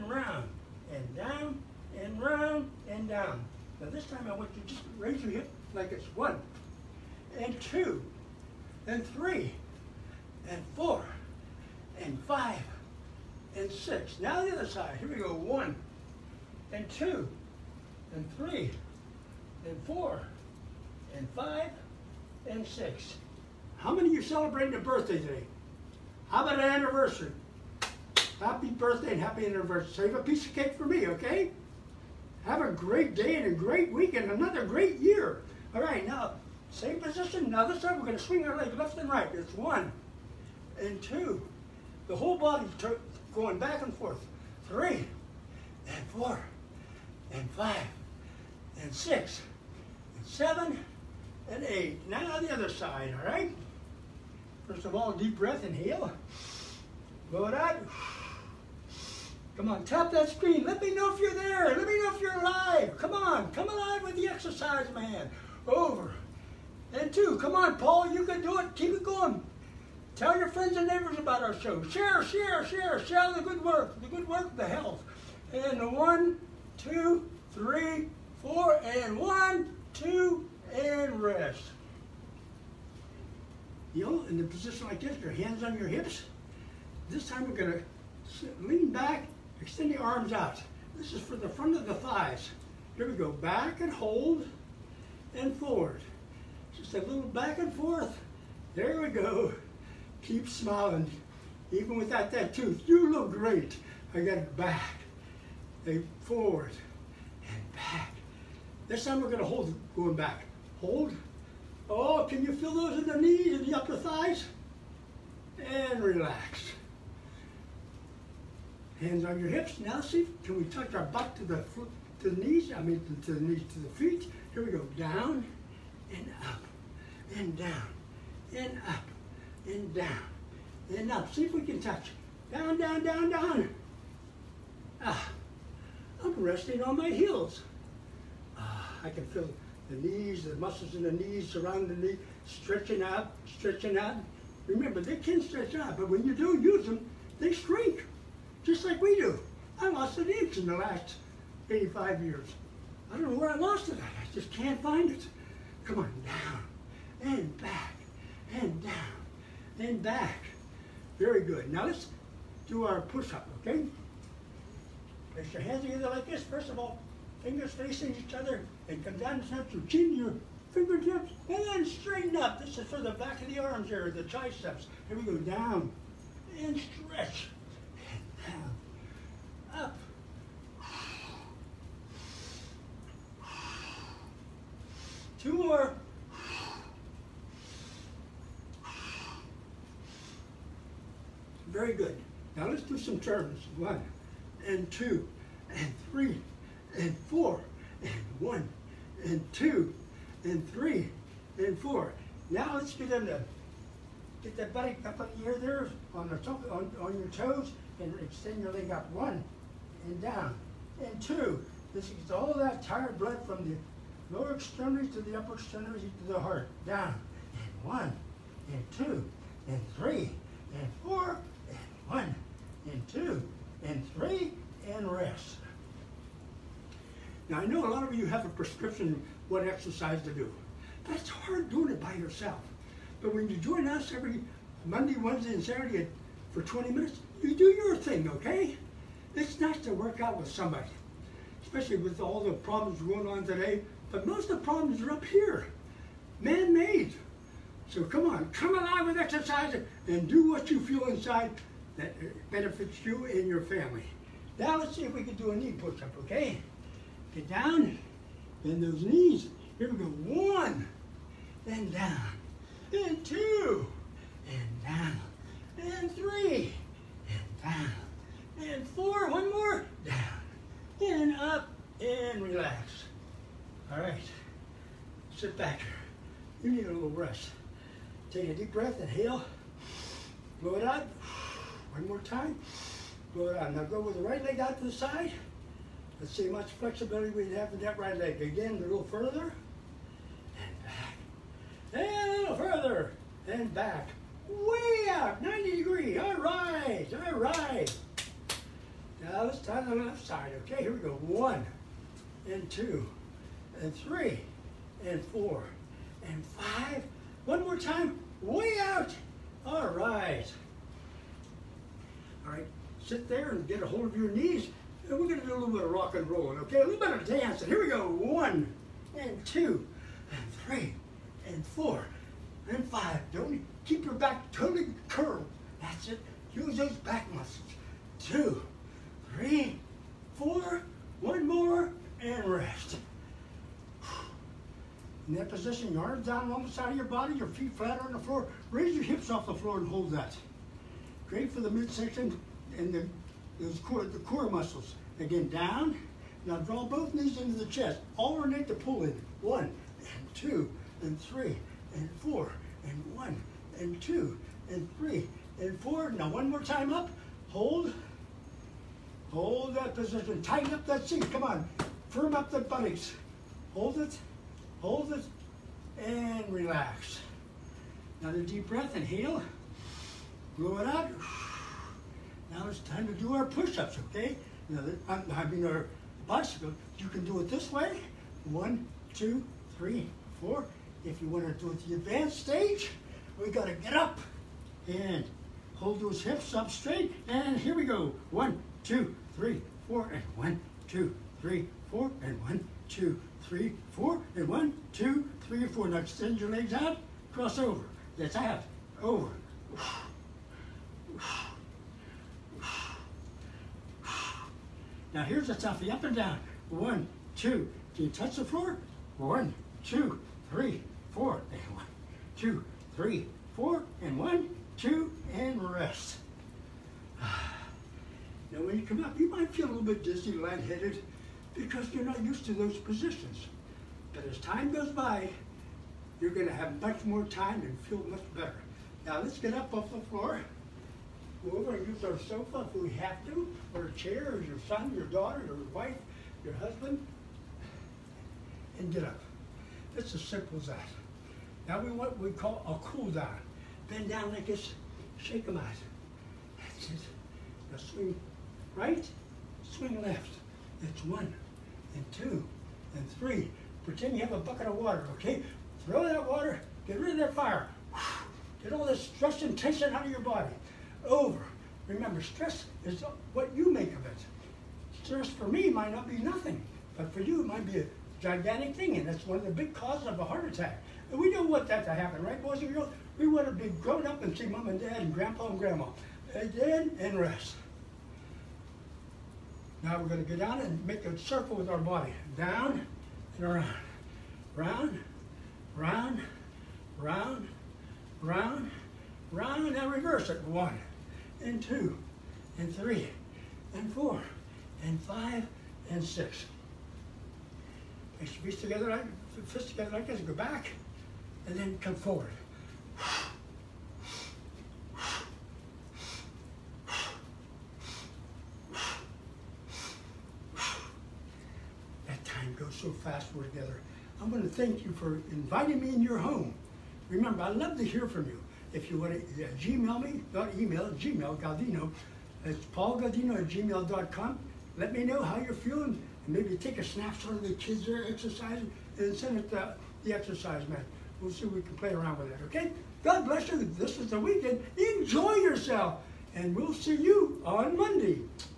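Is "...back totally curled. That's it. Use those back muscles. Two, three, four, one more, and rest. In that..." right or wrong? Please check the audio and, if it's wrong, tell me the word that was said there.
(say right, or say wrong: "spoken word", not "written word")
right.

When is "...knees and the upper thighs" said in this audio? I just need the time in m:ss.
1:53.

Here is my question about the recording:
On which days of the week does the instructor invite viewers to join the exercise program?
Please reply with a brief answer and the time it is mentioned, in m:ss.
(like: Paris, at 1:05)
Monday, Wednesday, and Saturday, at 3:54.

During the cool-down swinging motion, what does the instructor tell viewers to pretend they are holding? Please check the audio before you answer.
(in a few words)
a bucket of water.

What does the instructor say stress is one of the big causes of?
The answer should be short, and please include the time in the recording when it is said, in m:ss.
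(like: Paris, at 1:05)
a heart attack, at 7:50.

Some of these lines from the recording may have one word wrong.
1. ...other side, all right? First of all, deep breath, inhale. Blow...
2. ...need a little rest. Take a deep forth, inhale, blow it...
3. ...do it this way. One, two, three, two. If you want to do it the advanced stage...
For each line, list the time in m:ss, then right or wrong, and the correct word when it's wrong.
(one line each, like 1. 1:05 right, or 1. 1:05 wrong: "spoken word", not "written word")
1. 0:52 right
2. 4:36 wrong: "breath", not "forth"
3. 6:17 wrong: "four", not "two".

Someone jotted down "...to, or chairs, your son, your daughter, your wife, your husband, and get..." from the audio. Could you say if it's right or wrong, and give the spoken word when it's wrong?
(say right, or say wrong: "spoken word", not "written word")
right.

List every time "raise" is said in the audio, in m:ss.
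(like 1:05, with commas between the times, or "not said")
0:04, 5:38.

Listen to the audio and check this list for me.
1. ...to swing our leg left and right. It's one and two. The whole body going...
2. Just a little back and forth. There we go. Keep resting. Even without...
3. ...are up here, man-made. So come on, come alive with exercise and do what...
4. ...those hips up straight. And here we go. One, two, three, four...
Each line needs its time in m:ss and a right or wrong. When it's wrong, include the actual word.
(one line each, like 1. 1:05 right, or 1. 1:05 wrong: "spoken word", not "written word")
1. 0:38 right
2. 1:36 wrong: "smiling", not "resting"
3. 4:05 right
4. 6:26 right.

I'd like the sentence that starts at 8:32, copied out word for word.
That time goes so fast we're together.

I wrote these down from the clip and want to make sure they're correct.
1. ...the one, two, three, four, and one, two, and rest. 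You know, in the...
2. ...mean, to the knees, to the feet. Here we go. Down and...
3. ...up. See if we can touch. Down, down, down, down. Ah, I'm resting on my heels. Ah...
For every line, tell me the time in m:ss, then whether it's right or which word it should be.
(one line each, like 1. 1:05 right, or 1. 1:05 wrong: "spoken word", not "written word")
1. 1:15 right
2. 2:02 right
3. 2:11 right.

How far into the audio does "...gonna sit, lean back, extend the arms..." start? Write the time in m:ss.
1:27.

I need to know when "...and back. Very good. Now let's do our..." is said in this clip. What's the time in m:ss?
2:39.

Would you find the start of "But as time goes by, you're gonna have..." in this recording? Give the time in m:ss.
7:04.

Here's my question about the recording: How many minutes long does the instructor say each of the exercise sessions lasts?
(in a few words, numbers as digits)
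20.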